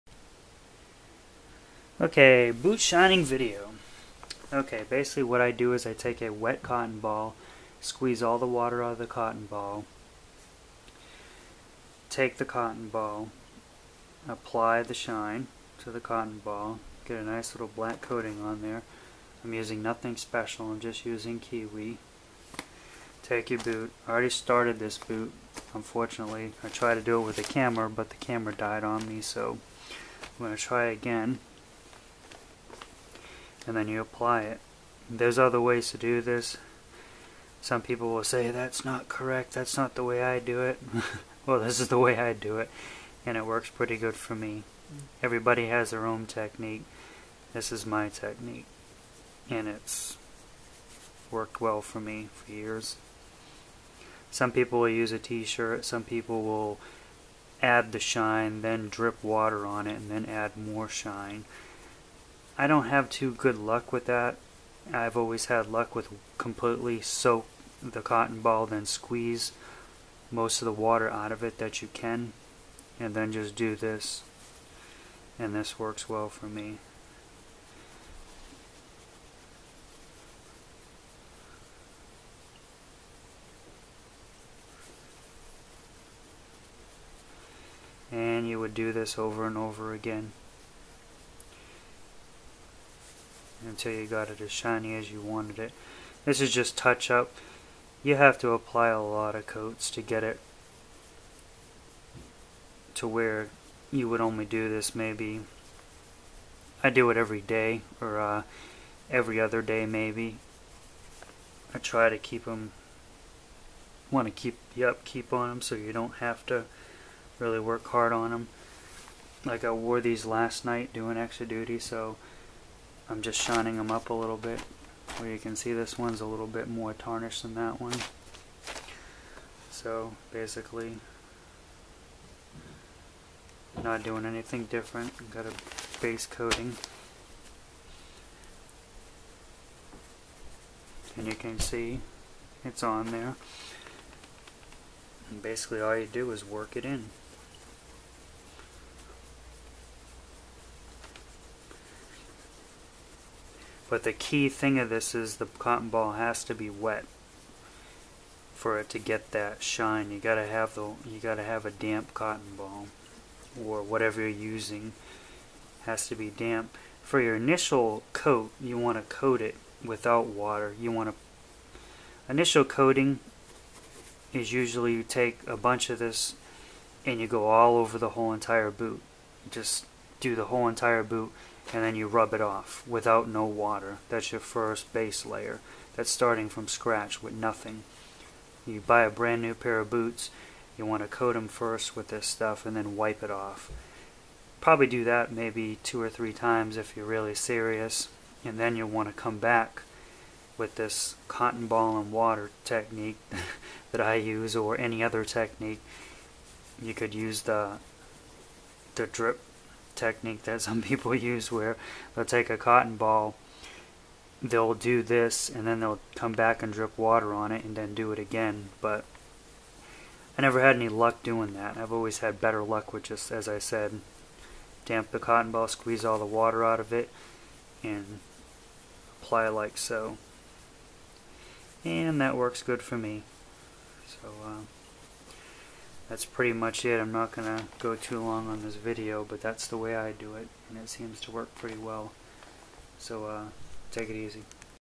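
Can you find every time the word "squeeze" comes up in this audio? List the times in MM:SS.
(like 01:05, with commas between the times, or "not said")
00:07, 01:08, 03:45.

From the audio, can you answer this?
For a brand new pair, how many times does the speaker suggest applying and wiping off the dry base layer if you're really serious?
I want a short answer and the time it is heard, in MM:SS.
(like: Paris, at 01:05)
2 or 3, at 03:15.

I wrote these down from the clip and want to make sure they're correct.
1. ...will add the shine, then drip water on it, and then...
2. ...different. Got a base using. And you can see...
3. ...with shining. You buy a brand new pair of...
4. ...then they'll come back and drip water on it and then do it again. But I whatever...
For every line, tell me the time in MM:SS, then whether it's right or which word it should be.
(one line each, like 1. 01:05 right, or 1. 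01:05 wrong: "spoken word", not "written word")
1. 00:56 right
2. 02:14 wrong: "coating", not "using"
3. 03:07 wrong: "nothing", not "shining"
4. 03:35 wrong: "never", not "whatever".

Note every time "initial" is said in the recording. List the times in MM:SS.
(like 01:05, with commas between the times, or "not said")
02:47, 02:52.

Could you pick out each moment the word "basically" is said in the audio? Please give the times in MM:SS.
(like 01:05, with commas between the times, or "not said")
00:04, 02:10, 02:25.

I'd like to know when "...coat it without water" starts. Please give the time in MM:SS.
02:49.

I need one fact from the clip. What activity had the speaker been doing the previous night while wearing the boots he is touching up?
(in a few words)
Extra duty.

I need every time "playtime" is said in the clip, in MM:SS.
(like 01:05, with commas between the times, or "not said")
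not said.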